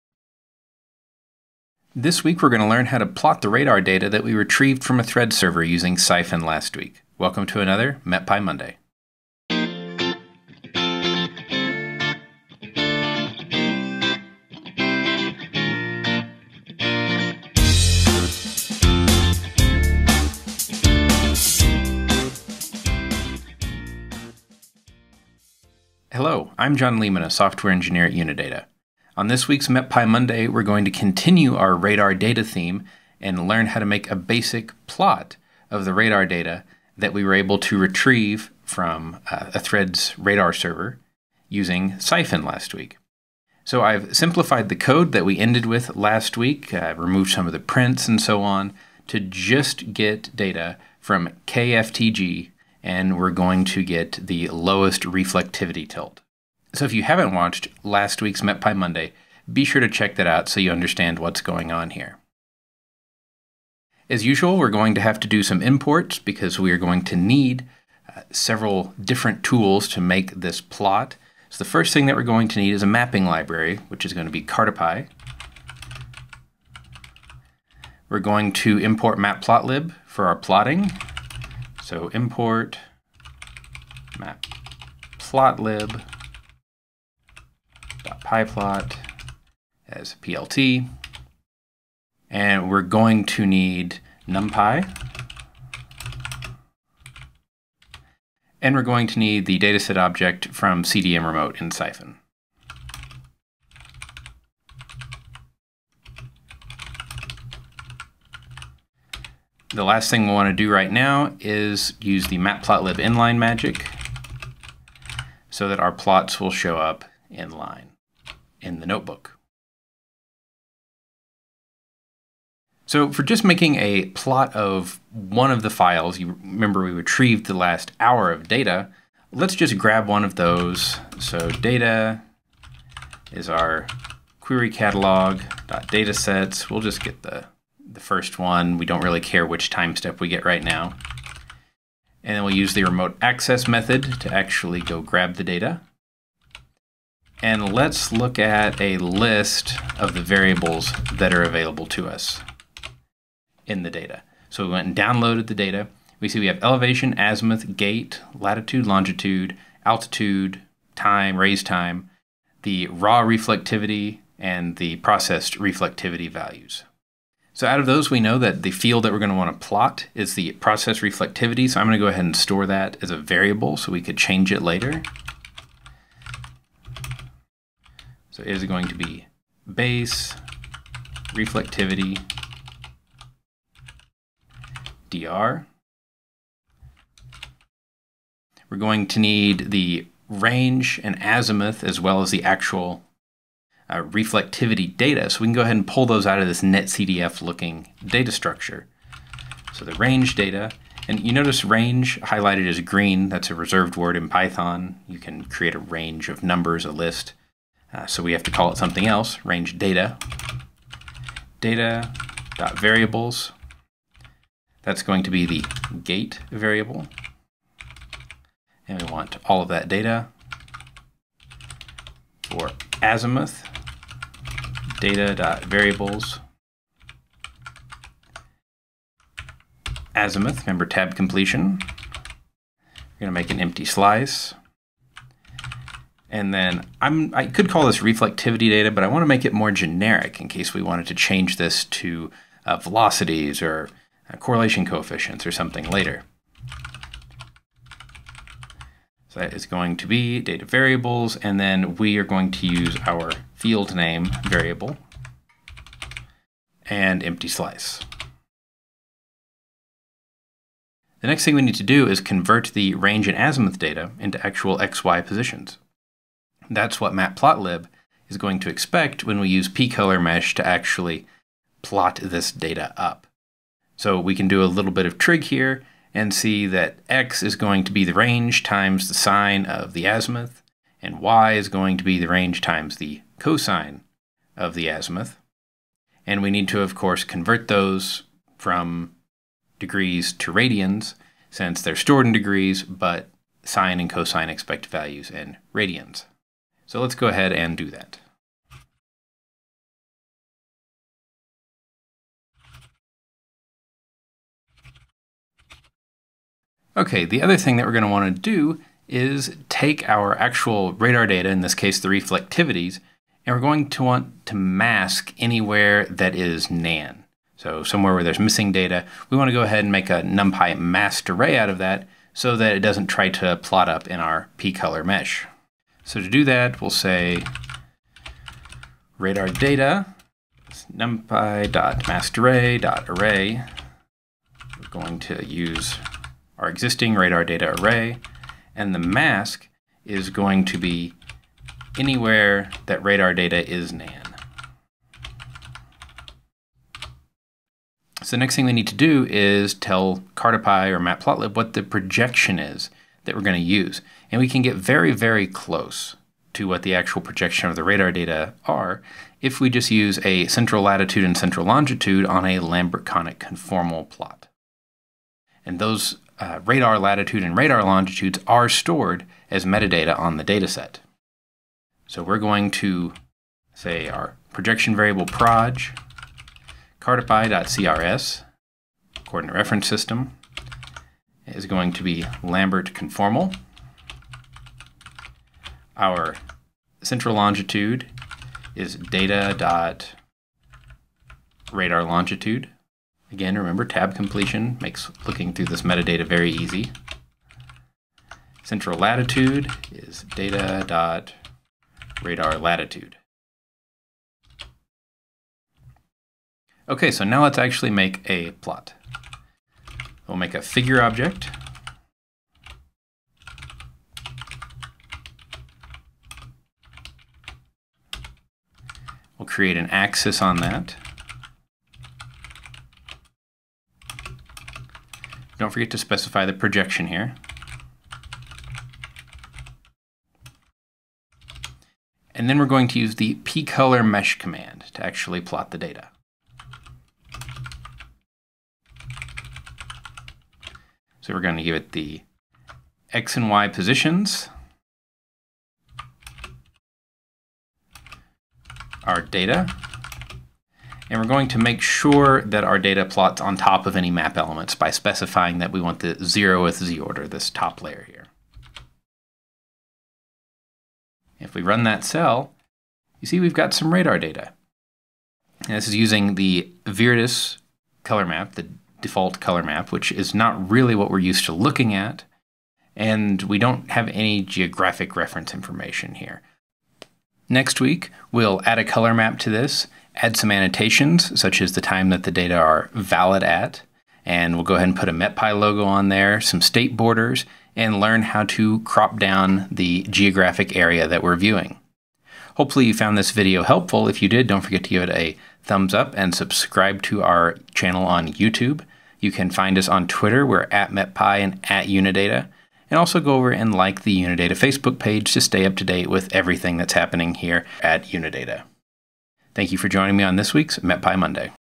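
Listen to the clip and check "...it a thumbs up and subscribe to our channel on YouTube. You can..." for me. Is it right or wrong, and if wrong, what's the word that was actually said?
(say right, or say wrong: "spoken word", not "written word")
right.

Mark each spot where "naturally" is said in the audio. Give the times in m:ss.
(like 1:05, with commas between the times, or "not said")
not said.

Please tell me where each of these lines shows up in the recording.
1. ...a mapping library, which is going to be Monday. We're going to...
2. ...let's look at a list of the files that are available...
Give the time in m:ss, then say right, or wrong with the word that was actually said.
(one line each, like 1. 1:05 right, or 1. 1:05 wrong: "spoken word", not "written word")
1. 1:12 wrong: "Cartopy", not "Monday"
2. 2:27 wrong: "variables", not "files".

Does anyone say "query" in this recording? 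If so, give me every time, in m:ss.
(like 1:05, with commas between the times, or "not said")
2:14.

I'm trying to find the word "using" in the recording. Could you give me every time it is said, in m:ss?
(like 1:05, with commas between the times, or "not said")
0:05, 0:41, 7:45.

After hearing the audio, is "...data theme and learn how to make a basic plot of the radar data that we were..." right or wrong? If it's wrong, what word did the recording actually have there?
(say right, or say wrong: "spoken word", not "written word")
right.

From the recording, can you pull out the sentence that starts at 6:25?
Our central longitude is data dot radar longitude.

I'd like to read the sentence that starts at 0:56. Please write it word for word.
So if you haven't watched last week's MetPy Monday, be sure to check that out so you understand what's going on here.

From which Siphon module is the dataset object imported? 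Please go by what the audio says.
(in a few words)
CDM remote.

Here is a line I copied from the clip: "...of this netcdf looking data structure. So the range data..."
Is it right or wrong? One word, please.
right.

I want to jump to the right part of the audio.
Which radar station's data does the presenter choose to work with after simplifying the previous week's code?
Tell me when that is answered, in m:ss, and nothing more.
0:51.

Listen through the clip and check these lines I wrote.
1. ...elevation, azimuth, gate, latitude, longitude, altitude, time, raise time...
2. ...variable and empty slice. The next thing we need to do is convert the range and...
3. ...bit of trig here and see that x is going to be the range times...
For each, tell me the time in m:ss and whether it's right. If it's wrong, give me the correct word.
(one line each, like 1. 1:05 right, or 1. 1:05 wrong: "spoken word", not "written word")
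1. 2:36 right
2. 4:14 right
3. 4:34 right.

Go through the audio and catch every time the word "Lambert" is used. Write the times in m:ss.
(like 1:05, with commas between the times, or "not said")
6:02, 6:22.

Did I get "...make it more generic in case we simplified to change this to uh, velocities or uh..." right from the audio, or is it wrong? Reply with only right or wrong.
wrong.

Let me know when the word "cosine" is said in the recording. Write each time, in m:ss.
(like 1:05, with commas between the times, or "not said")
4:43, 4:54.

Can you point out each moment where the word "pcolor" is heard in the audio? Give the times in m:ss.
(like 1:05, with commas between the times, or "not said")
4:29, 7:13.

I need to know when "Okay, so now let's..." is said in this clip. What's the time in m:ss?
6:46.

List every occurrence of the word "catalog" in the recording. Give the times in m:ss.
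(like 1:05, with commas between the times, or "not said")
2:14.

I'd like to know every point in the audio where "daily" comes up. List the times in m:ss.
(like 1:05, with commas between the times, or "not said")
not said.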